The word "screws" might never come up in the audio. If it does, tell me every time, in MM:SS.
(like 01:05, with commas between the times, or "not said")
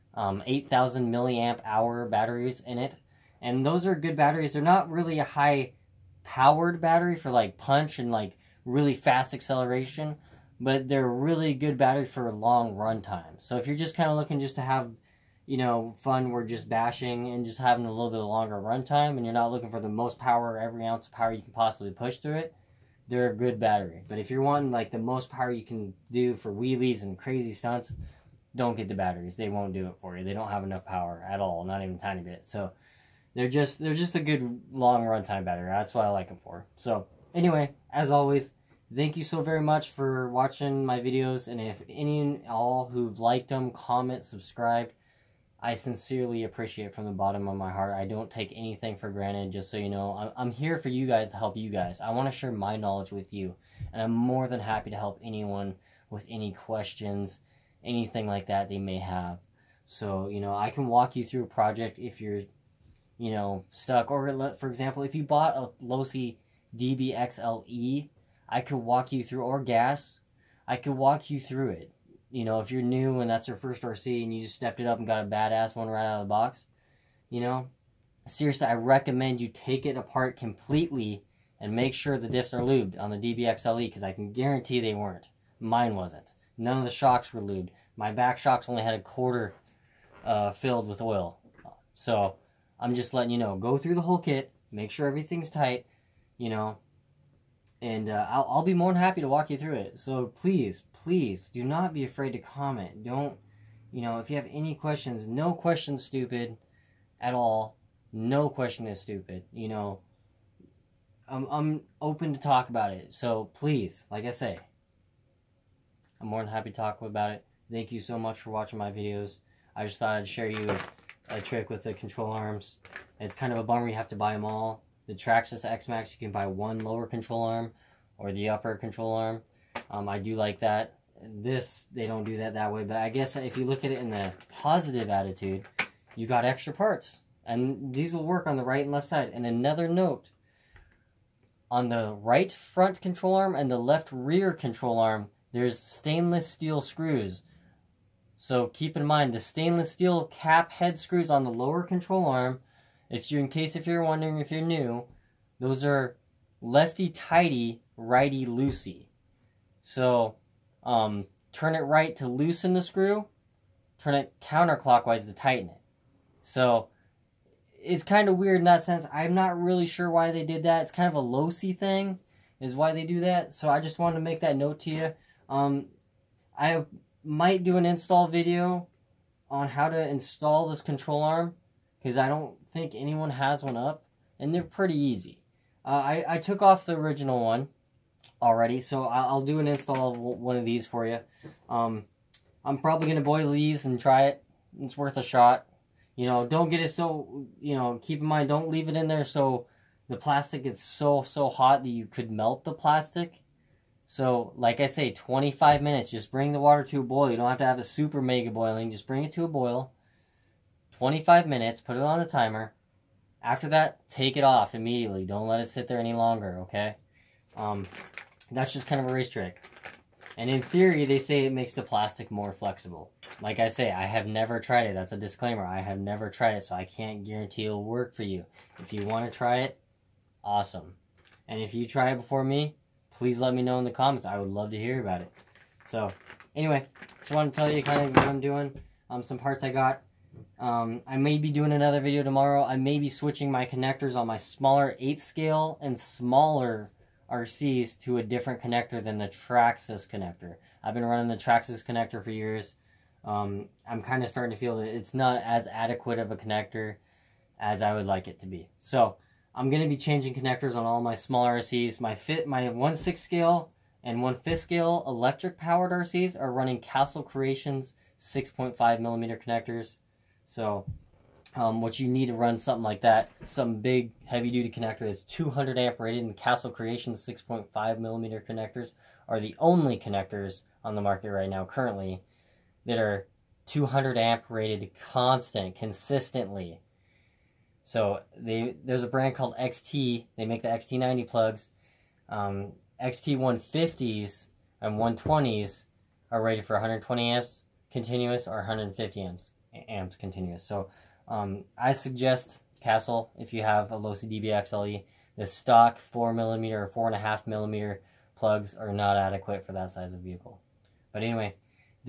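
02:26, 02:30, 02:42.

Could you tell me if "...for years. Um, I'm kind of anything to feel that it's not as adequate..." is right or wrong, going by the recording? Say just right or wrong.
wrong.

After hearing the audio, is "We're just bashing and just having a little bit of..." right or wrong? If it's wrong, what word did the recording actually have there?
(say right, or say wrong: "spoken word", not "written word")
right.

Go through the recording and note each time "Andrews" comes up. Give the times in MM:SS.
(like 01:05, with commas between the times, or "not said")
not said.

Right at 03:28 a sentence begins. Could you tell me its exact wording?
Just bring it to a boil.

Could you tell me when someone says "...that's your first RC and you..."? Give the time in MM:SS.
01:13.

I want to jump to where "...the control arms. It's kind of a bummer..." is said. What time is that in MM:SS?
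02:01.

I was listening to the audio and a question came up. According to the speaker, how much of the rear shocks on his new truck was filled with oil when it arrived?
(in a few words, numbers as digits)
a quarter.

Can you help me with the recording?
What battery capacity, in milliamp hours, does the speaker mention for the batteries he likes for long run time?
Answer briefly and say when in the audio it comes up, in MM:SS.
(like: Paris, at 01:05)
8000, at 00:00.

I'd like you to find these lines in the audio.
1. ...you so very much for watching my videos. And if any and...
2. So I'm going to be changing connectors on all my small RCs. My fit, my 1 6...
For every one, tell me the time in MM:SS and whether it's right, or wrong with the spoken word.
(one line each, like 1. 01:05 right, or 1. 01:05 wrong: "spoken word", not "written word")
1. 00:39 right
2. 04:18 right.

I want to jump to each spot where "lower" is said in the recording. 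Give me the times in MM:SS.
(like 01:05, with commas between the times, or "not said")
02:06, 02:31.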